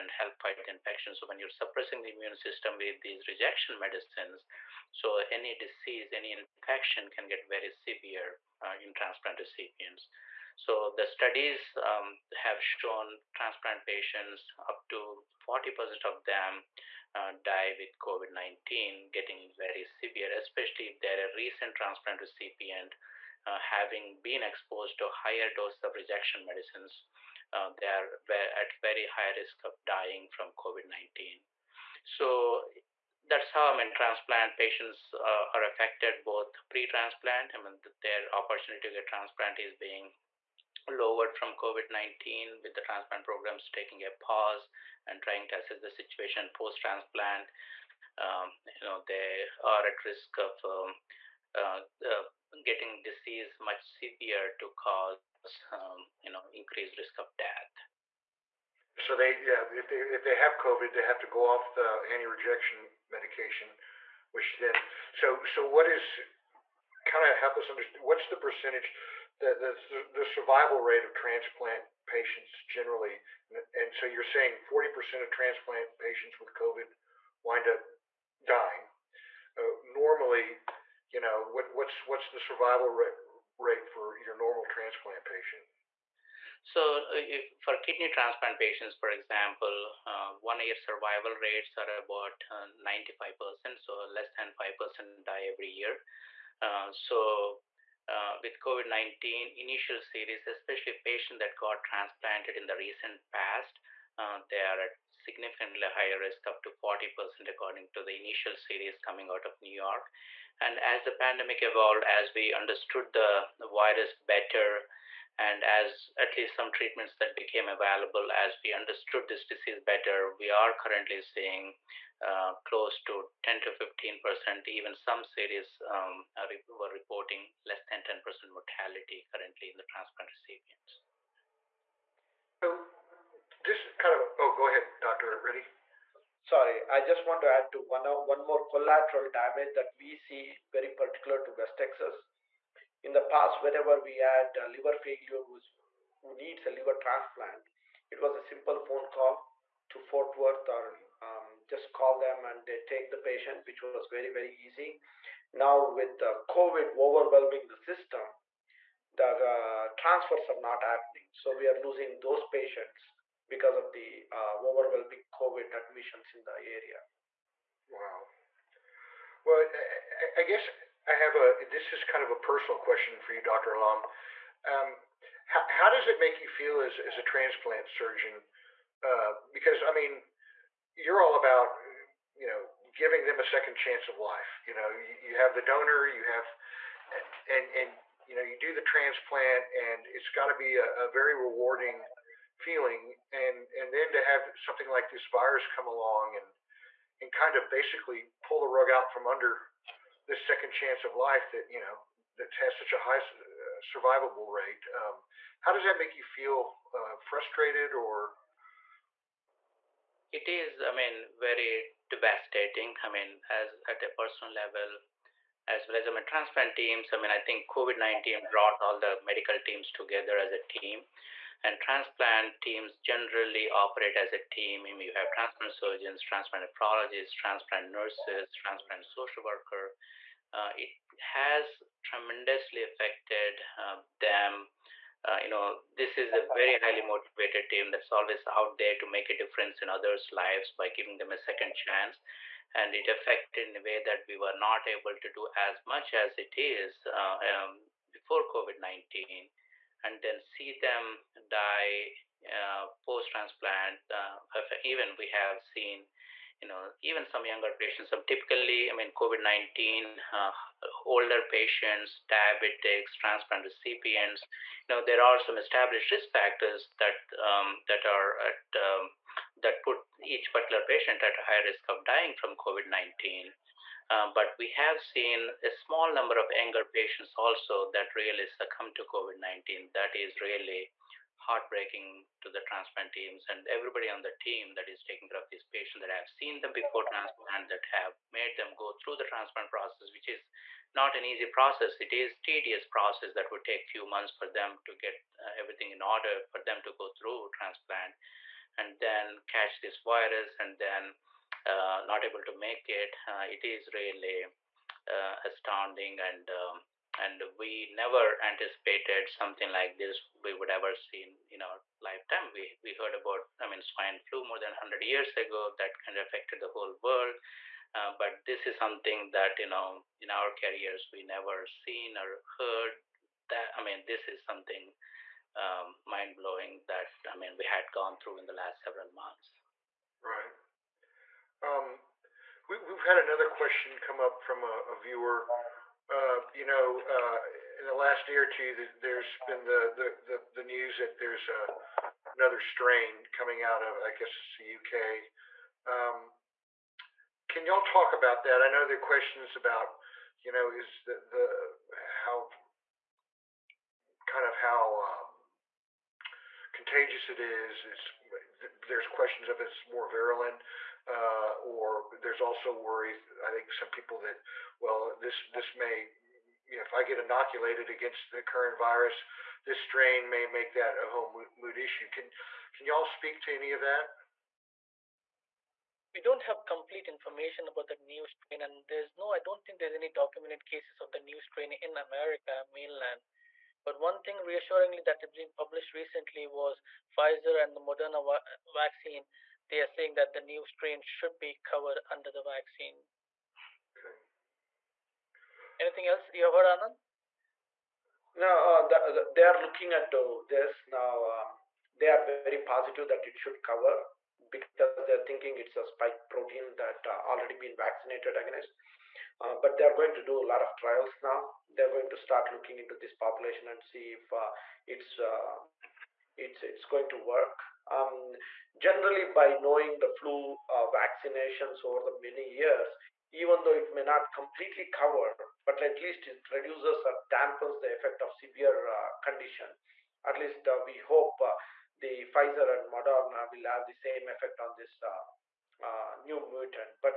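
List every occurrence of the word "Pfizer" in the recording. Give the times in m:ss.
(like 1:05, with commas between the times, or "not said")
6:27, 7:12.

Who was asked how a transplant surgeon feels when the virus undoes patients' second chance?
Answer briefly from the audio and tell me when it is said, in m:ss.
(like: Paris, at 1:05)
Dr. Allam, at 2:53.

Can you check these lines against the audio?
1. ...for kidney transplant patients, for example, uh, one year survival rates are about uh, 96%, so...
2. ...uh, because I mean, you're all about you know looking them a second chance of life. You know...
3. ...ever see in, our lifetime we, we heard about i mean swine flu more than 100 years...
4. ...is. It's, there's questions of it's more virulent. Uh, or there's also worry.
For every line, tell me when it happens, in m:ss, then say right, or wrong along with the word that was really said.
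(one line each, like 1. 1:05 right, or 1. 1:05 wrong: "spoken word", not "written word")
1. 1:27 wrong: "95", not "96"
2. 2:59 wrong: "giving", not "looking"
3. 5:10 right
4. 5:57 right.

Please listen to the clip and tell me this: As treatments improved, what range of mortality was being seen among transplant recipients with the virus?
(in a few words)
10 to 15 percent.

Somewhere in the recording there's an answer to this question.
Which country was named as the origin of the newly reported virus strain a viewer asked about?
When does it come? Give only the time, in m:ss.
5:44.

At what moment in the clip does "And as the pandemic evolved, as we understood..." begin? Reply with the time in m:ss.
1:50.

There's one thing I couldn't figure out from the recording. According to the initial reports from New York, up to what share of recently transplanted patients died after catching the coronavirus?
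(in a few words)
40%.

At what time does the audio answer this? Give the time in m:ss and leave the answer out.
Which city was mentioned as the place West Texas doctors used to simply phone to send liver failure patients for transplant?
2:29.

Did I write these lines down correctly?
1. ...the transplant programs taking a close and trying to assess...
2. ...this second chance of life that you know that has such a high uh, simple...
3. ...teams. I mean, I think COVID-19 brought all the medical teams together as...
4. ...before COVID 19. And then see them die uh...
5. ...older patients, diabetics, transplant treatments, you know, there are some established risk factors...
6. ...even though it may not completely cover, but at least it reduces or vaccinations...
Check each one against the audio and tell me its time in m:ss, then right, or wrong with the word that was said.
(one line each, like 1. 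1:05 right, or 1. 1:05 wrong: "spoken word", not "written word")
1. 0:42 wrong: "pause", not "close"
2. 3:20 wrong: "survivable", not "simple"
3. 3:36 right
4. 4:08 right
5. 4:21 wrong: "recipients", not "treatments"
6. 7:03 wrong: "dampens", not "vaccinations".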